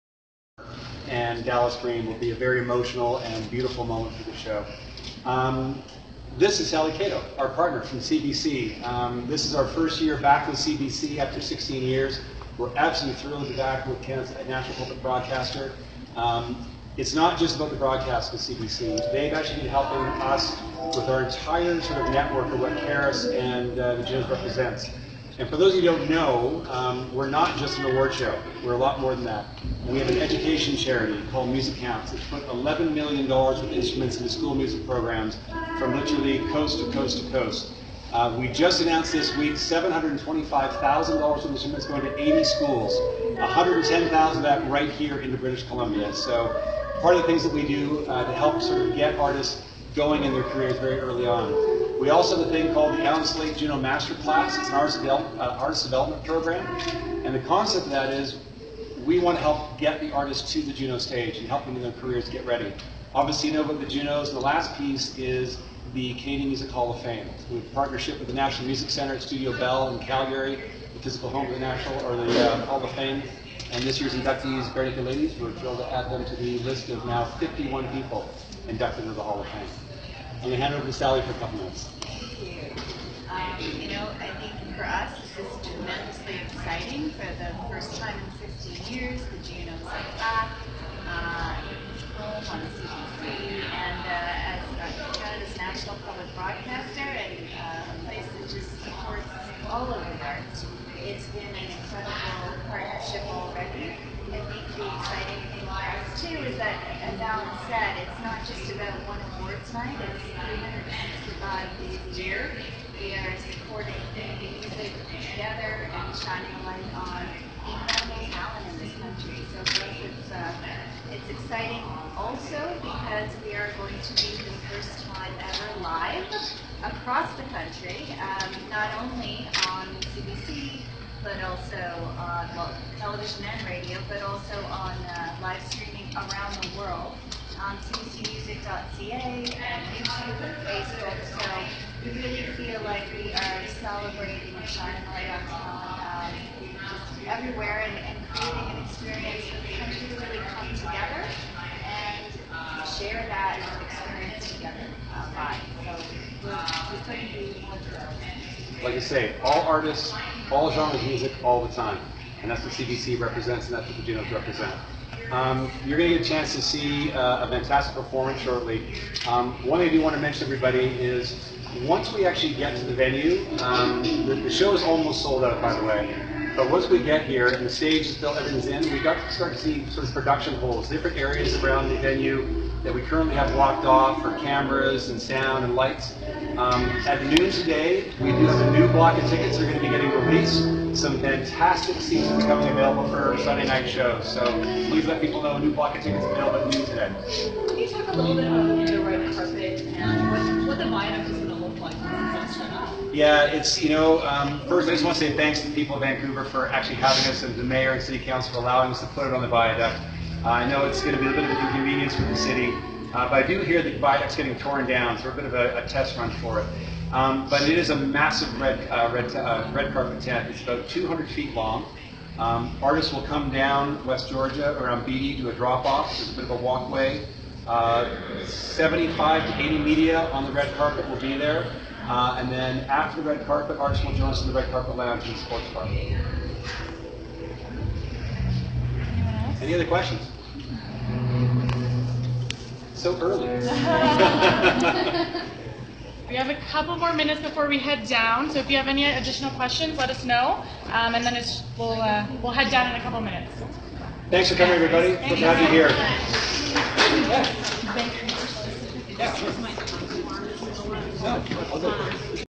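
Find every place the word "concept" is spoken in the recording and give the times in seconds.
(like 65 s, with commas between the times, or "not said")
57 s.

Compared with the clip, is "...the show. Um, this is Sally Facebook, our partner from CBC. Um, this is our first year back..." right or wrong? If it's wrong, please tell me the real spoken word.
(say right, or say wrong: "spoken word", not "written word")
wrong: "Cato", not "Facebook".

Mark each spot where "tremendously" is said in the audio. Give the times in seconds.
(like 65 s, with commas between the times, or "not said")
85 s.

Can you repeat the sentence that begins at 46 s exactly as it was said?
So part of the things that we do uh, to help sort of get artists going in their careers very early on.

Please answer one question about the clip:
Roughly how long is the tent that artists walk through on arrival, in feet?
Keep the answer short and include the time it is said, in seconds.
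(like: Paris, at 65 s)
200 feet, at 220 s.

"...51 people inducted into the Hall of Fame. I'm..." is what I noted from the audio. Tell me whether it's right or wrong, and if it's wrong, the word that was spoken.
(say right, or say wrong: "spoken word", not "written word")
right.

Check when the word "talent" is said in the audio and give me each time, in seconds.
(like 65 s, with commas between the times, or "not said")
118 s, 145 s.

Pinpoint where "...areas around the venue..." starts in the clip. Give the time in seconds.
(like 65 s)
181 s.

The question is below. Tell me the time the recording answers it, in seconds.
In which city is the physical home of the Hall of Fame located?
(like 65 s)
70 s.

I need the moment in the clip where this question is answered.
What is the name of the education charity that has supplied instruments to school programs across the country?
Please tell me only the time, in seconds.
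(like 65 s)
31 s.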